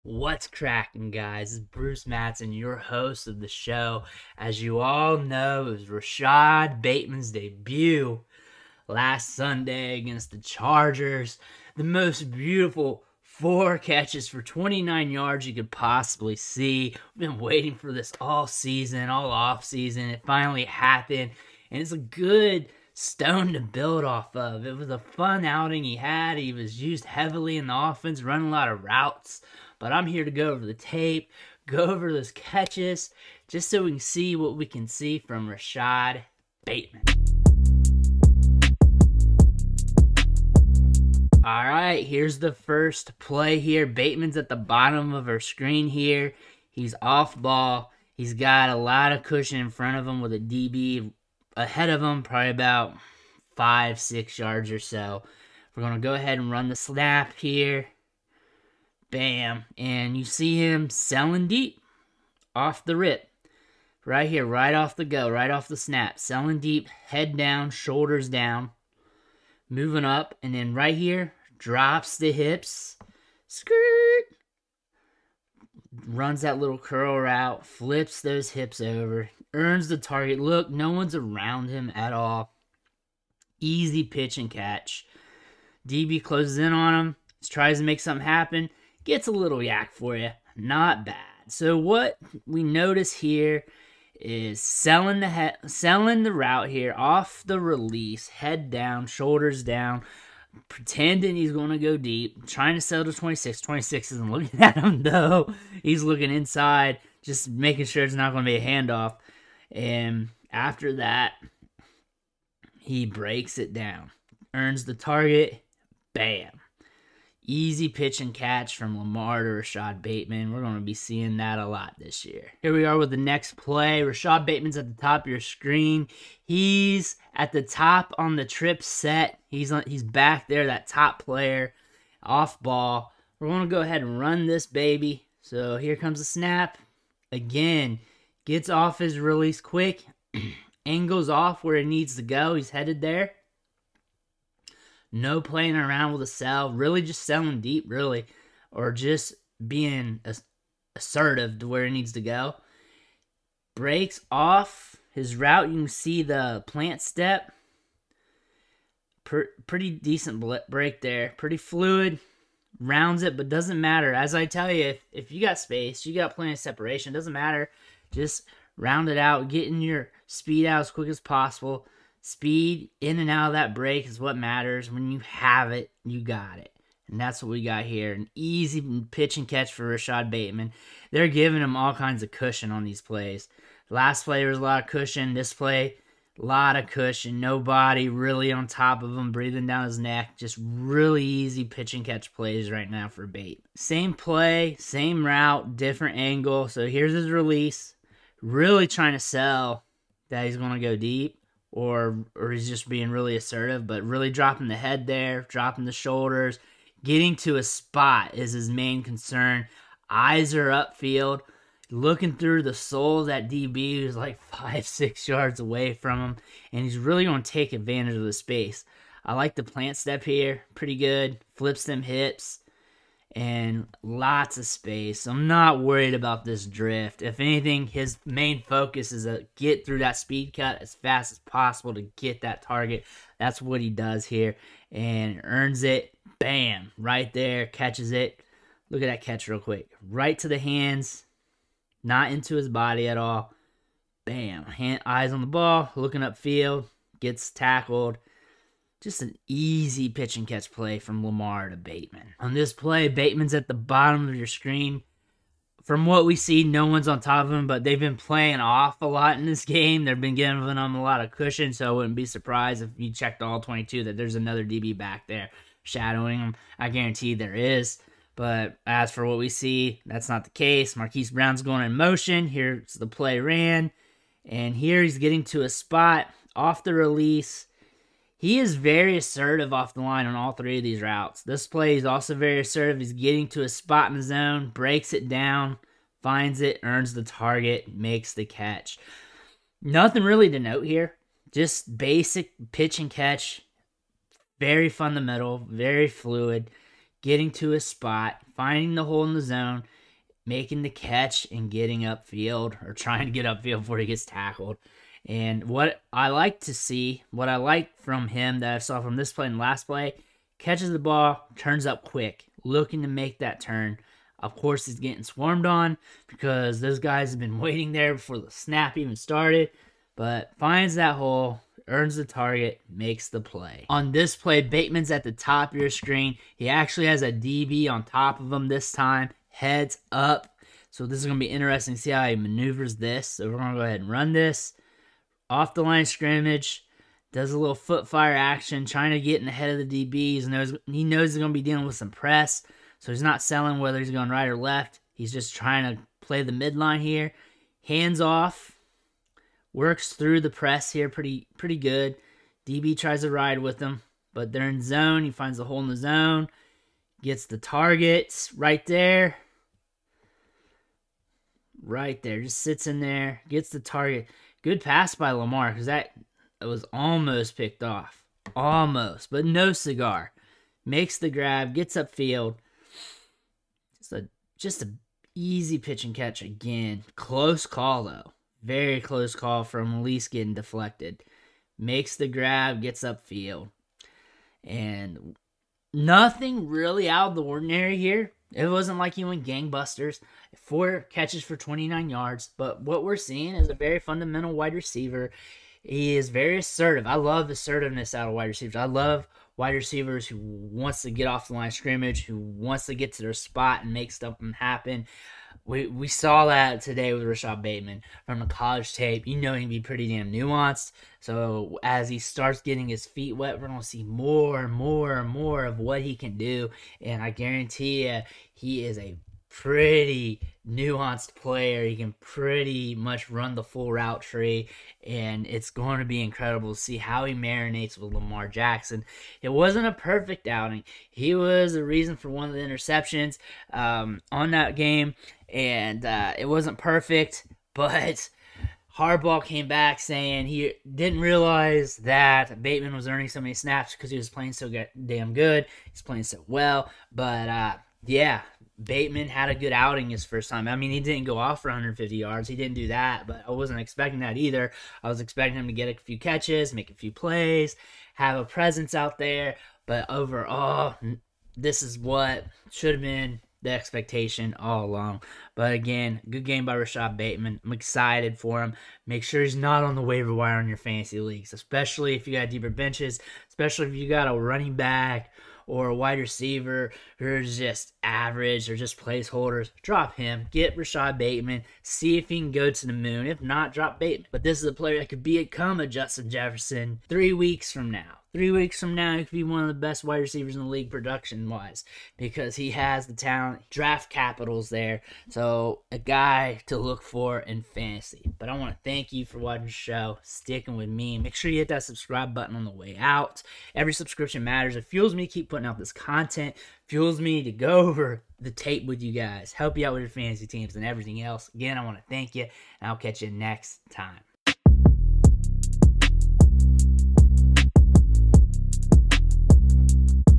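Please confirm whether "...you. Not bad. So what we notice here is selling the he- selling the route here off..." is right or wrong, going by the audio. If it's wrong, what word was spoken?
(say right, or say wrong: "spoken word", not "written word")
right.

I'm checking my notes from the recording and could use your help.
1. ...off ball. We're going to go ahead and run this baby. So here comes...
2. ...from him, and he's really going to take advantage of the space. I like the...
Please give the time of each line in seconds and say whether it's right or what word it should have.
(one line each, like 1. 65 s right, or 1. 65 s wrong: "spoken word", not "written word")
1. 132 s right
2. 215 s right.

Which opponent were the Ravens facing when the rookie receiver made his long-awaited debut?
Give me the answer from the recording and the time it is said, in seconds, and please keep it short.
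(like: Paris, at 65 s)
Chargers, at 10 s.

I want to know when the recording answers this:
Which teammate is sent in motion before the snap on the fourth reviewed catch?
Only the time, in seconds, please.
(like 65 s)
270 s.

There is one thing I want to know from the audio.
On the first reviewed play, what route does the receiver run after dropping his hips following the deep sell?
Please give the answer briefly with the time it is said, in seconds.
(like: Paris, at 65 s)
Curl, at 76 s.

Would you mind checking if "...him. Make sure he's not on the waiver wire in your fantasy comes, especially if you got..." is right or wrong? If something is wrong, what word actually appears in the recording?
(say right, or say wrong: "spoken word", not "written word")
wrong: "leagues", not "comes".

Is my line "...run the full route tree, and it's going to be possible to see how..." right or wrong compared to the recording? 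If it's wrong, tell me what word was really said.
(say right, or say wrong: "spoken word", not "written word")
wrong: "incredible", not "possible".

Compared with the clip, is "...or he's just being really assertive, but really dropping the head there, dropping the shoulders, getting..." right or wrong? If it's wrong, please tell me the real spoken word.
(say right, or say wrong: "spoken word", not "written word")
right.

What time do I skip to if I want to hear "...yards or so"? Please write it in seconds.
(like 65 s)
54 s.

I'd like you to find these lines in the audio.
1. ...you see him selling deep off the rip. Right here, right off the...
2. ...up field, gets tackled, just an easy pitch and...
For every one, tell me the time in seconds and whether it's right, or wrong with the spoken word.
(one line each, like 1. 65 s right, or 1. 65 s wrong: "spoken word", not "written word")
1. 60 s right
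2. 246 s right.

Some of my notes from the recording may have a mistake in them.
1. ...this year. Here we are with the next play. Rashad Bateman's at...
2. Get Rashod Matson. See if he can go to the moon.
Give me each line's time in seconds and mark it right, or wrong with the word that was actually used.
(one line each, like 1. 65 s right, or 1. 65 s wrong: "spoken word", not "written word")
1. 121 s right
2. 480 s wrong: "Bateman", not "Matson".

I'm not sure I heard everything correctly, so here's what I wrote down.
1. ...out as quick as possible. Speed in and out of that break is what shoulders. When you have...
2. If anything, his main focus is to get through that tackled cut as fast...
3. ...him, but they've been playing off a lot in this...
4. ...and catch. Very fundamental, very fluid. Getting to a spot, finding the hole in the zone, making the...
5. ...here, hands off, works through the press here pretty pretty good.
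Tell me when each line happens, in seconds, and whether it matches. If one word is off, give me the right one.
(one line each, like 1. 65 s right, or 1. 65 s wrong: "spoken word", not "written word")
1. 170 s wrong: "matters", not "shoulders"
2. 227 s wrong: "speed", not "tackled"
3. 257 s right
4. 292 s right
5. 347 s right.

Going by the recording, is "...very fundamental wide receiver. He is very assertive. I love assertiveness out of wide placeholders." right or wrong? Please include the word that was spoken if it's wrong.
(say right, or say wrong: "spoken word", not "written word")
wrong: "receivers", not "placeholders".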